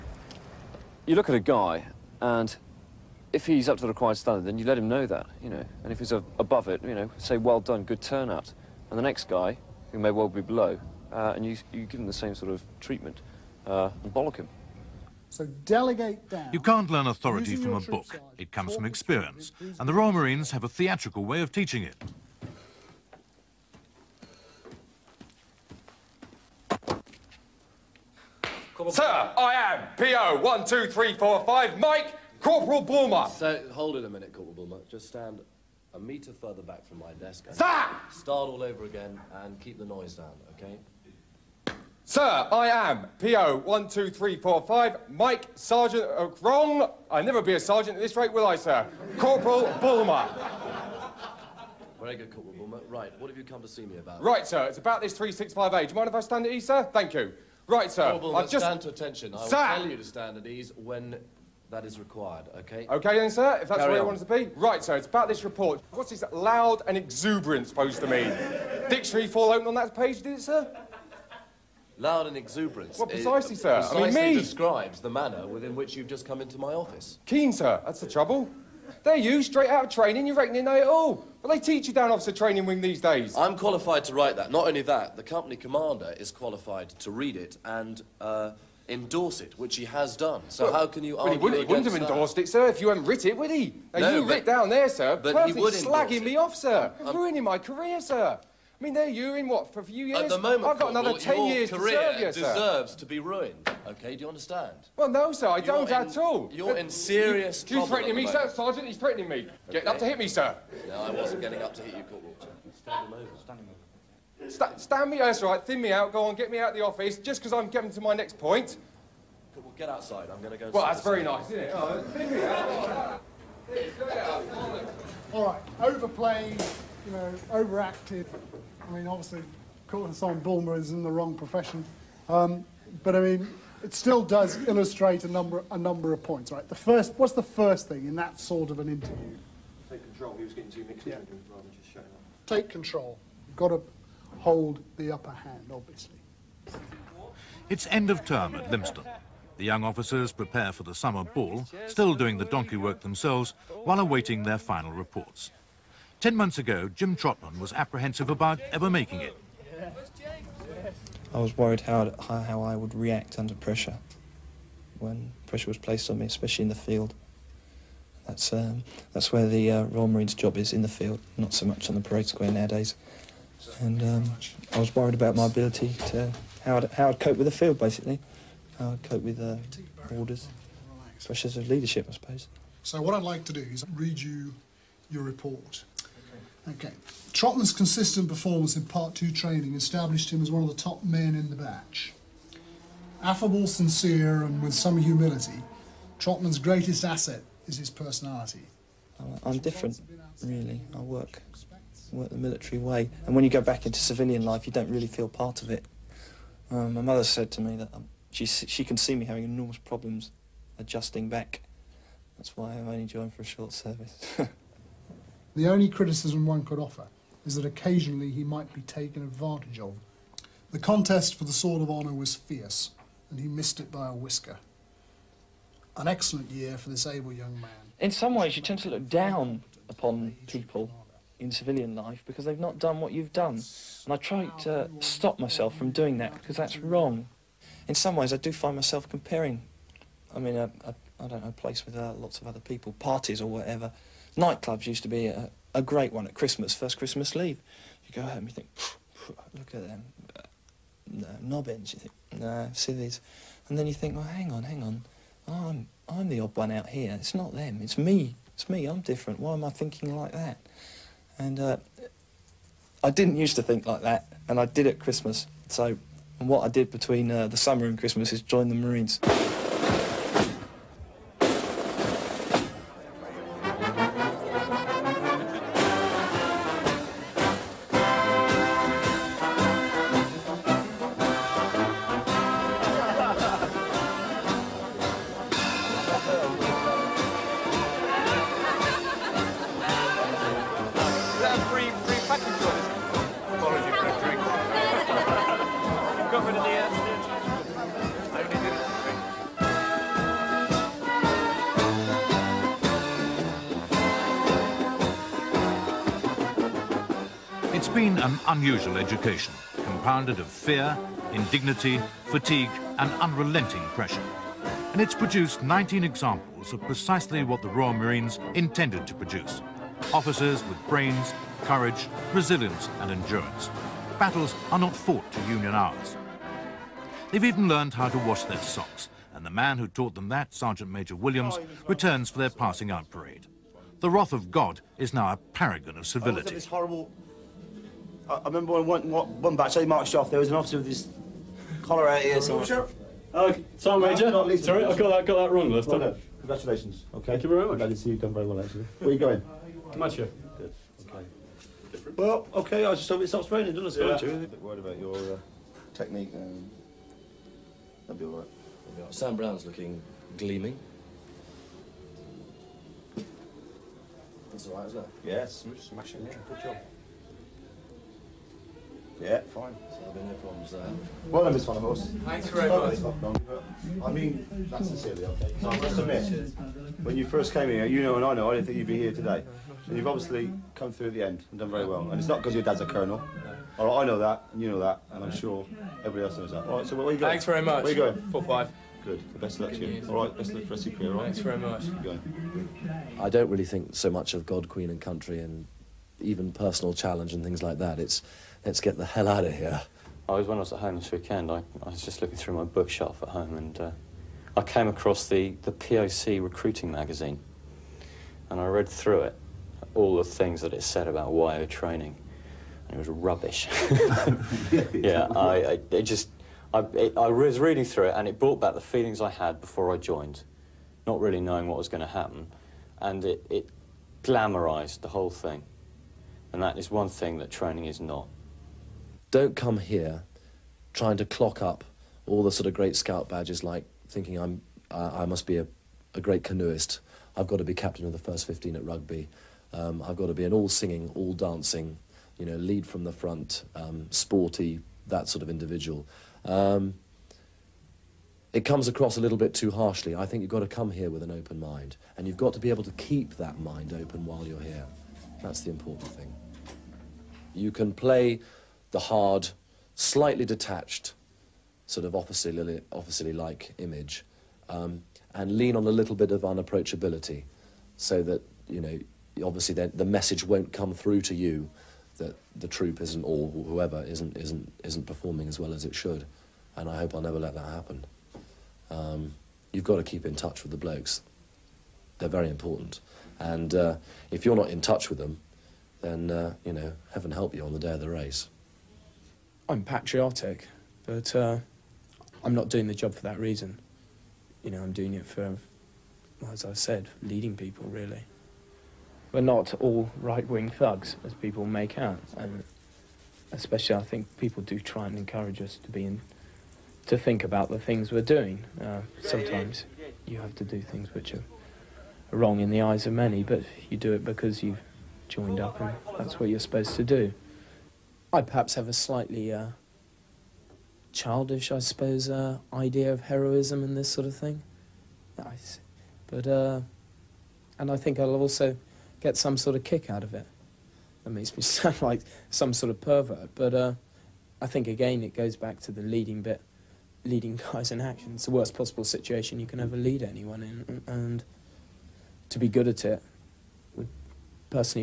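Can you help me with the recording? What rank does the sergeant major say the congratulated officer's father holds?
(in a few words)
Colonel.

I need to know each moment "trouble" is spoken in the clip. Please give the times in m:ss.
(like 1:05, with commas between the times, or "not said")
1:18, 1:47.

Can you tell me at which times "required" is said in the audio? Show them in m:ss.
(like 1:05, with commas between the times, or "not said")
0:03, 1:01.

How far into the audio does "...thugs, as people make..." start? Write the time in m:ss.
8:20.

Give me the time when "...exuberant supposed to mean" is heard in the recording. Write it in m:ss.
1:06.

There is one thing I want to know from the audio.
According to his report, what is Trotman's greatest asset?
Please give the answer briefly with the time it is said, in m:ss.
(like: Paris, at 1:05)
His personality, at 3:17.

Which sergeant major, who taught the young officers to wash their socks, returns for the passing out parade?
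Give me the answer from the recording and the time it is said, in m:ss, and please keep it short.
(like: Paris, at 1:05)
Williams, at 5:30.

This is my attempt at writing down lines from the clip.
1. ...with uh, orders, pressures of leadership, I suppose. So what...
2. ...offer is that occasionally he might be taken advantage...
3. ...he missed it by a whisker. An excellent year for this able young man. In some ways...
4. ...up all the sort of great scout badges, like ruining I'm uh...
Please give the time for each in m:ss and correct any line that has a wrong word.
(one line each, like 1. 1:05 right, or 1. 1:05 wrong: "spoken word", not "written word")
1. 2:59 right
2. 3:36 right
3. 3:43 right
4. 7:11 wrong: "thinking", not "ruining".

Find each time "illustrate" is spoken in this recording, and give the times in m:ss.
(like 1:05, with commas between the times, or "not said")
2:14.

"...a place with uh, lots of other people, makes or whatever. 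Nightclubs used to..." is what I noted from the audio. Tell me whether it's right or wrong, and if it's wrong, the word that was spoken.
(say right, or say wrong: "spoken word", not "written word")
wrong: "parties", not "makes".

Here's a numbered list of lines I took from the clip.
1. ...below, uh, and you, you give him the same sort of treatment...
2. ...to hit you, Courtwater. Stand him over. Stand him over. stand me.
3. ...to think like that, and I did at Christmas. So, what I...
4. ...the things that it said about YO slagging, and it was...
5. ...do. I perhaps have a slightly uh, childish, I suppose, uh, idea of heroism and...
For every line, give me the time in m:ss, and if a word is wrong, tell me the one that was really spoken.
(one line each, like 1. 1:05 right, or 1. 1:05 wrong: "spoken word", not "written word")
1. 0:10 right
2. 1:51 right
3. 4:23 right
4. 6:50 wrong: "training", not "slagging"
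5. 8:37 right.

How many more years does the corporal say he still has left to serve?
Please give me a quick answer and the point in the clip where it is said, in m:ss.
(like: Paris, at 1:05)
10, at 1:41.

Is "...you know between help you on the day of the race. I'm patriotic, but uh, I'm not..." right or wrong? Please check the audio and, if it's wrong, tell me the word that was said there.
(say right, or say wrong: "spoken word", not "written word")
wrong: "heaven", not "between".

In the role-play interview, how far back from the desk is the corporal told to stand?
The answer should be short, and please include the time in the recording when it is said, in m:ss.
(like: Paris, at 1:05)
1 meter, at 0:35.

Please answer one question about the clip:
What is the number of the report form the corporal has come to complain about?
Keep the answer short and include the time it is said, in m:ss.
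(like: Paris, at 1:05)
365A, at 0:55.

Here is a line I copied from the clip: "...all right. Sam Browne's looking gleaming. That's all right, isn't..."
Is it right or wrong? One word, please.
right.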